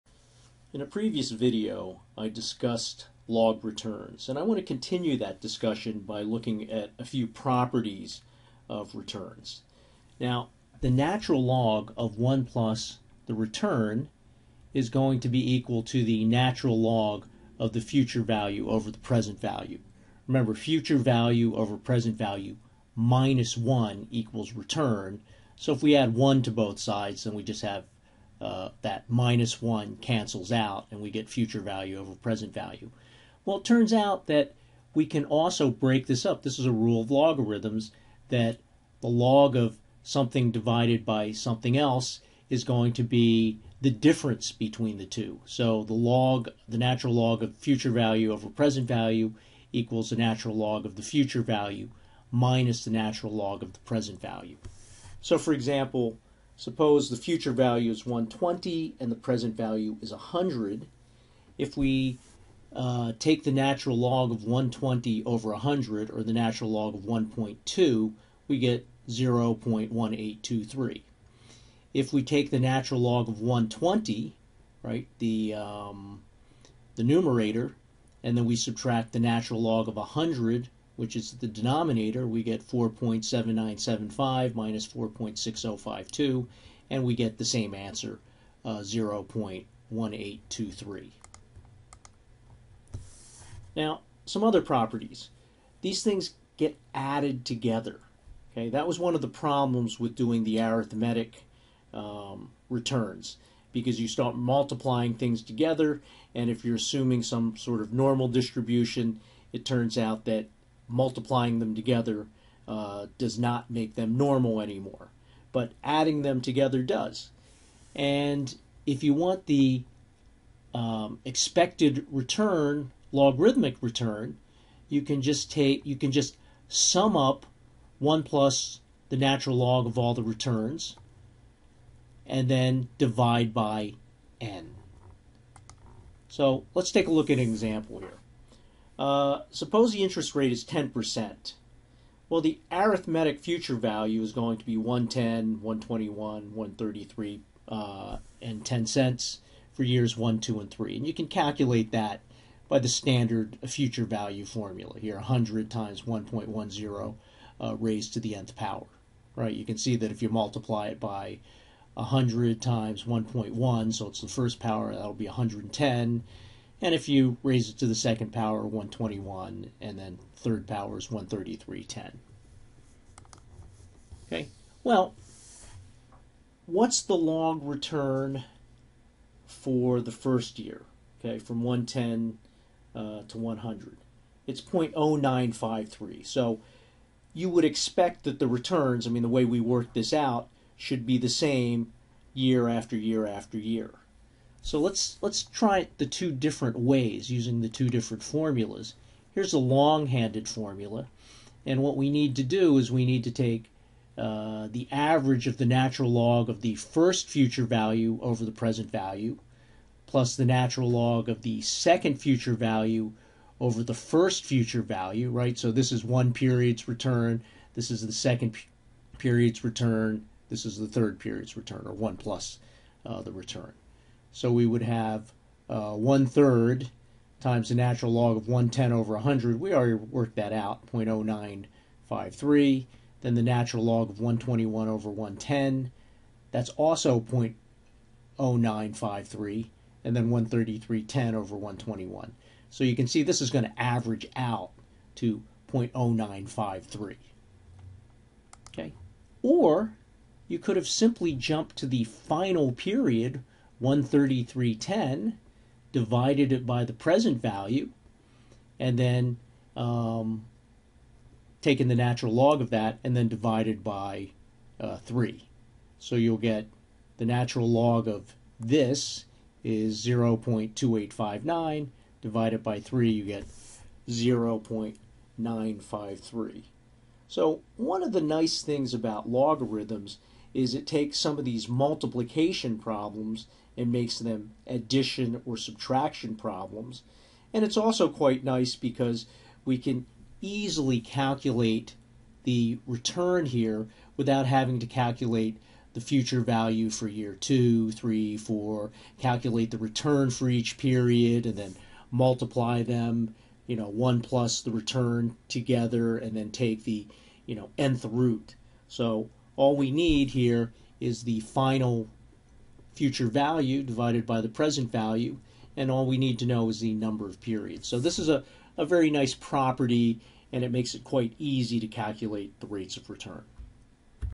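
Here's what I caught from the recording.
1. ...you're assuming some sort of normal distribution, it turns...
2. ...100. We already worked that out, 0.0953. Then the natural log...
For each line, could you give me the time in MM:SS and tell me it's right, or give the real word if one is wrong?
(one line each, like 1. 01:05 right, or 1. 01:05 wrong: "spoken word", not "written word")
1. 01:46 right
2. 03:49 right.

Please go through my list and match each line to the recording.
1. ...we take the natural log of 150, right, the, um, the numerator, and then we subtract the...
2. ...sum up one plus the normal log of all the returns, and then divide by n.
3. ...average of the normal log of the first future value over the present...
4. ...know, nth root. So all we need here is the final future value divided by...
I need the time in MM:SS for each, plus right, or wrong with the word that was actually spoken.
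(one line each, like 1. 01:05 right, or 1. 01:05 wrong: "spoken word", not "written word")
1. 01:12 wrong: "120", not "150"
2. 02:06 wrong: "natural", not "normal"
3. 03:24 wrong: "natural", not "normal"
4. 05:07 right.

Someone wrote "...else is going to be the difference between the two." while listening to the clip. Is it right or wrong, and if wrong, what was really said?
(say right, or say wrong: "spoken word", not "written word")
right.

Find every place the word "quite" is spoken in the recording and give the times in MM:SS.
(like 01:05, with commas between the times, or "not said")
04:48, 05:21.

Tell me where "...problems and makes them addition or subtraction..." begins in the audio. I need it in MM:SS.
04:42.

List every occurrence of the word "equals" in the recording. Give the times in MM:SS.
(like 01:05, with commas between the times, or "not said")
00:15, 00:24, 00:49.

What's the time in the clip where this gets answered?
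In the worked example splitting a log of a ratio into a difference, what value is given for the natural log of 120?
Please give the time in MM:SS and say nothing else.
01:22.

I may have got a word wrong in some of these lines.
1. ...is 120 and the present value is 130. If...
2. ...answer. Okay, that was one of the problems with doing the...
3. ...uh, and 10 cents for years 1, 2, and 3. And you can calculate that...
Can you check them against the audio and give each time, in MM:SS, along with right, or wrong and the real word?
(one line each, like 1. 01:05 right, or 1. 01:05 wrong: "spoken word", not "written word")
1. 00:57 wrong: "100", not "130"
2. 01:37 wrong: "together", not "answer"
3. 02:27 right.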